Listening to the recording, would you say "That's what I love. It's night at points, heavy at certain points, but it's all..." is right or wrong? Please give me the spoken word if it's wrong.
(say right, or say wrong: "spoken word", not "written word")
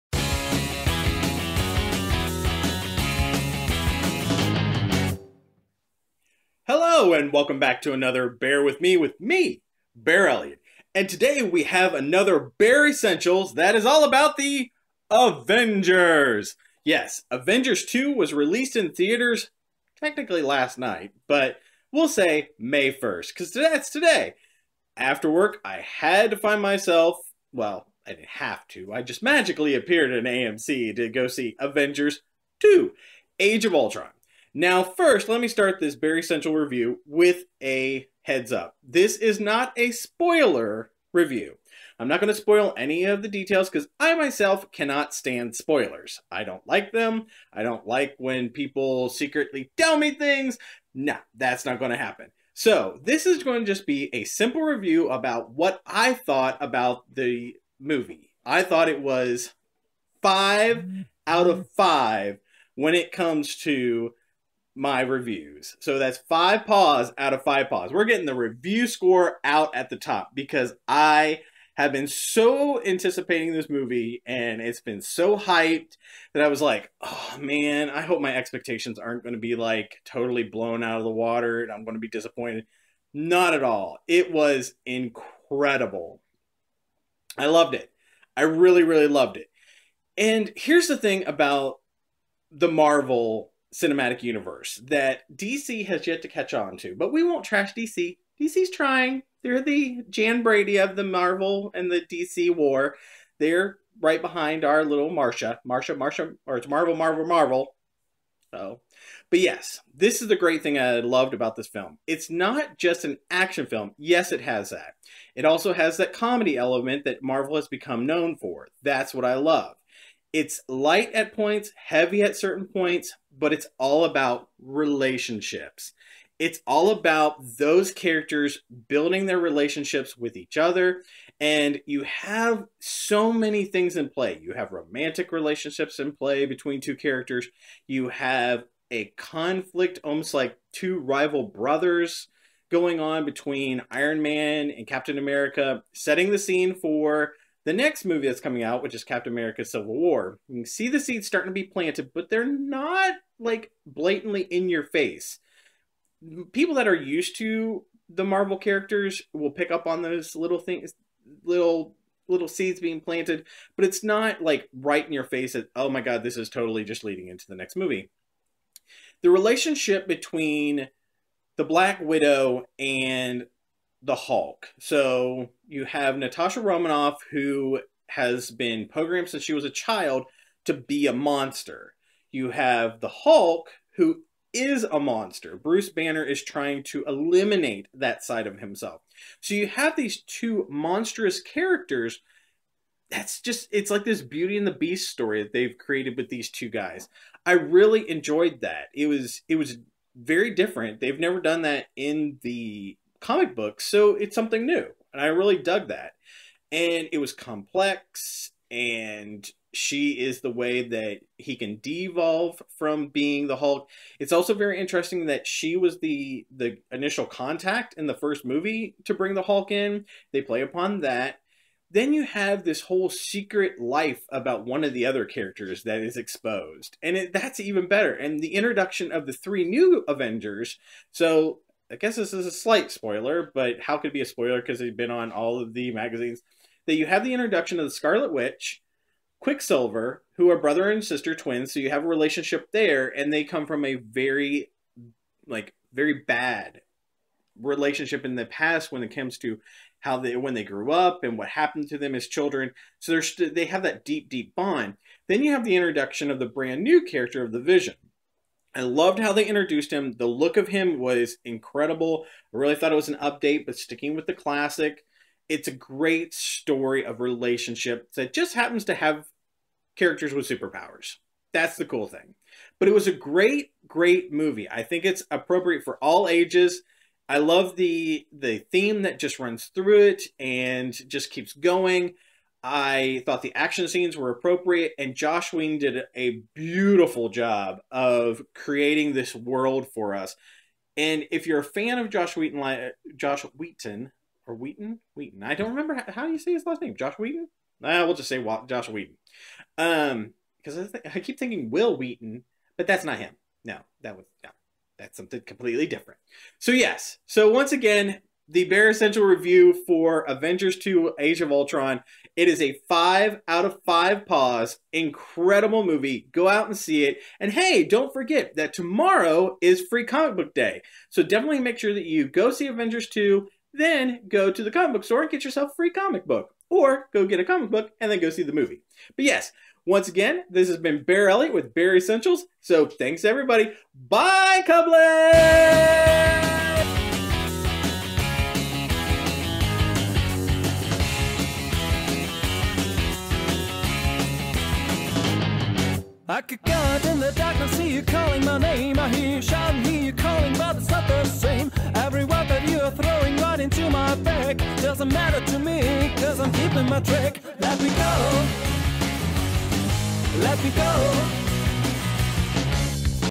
wrong: "light", not "night".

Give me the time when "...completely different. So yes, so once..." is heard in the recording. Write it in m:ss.
5:05.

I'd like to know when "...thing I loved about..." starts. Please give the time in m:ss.
1:50.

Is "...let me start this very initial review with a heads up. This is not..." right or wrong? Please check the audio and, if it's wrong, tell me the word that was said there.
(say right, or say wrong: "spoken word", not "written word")
wrong: "essential", not "initial".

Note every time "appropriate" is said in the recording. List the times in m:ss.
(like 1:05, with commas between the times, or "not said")
4:35, 4:44.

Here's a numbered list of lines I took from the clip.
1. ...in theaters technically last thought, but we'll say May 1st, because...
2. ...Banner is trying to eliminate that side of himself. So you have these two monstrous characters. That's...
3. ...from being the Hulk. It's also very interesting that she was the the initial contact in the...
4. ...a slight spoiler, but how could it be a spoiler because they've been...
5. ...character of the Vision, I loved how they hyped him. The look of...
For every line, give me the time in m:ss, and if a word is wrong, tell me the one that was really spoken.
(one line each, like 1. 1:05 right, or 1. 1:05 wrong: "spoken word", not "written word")
1. 0:18 wrong: "night", not "thought"
2. 3:05 right
3. 3:32 right
4. 3:52 right
5. 4:17 wrong: "introduced", not "hyped".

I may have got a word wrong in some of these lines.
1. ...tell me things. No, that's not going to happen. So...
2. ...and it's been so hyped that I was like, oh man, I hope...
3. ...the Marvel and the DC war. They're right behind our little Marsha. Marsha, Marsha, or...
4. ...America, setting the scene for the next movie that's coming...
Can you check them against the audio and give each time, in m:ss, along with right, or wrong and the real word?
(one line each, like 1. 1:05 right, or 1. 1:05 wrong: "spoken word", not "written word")
1. 0:49 right
2. 1:14 right
3. 1:40 right
4. 2:25 right.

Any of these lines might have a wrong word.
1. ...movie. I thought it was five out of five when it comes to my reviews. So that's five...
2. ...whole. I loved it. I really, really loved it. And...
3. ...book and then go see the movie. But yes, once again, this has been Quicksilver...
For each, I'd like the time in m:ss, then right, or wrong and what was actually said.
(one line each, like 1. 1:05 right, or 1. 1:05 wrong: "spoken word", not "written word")
1. 0:57 right
2. 1:24 wrong: "incredible", not "whole"
3. 5:27 wrong: "Bear", not "Quicksilver".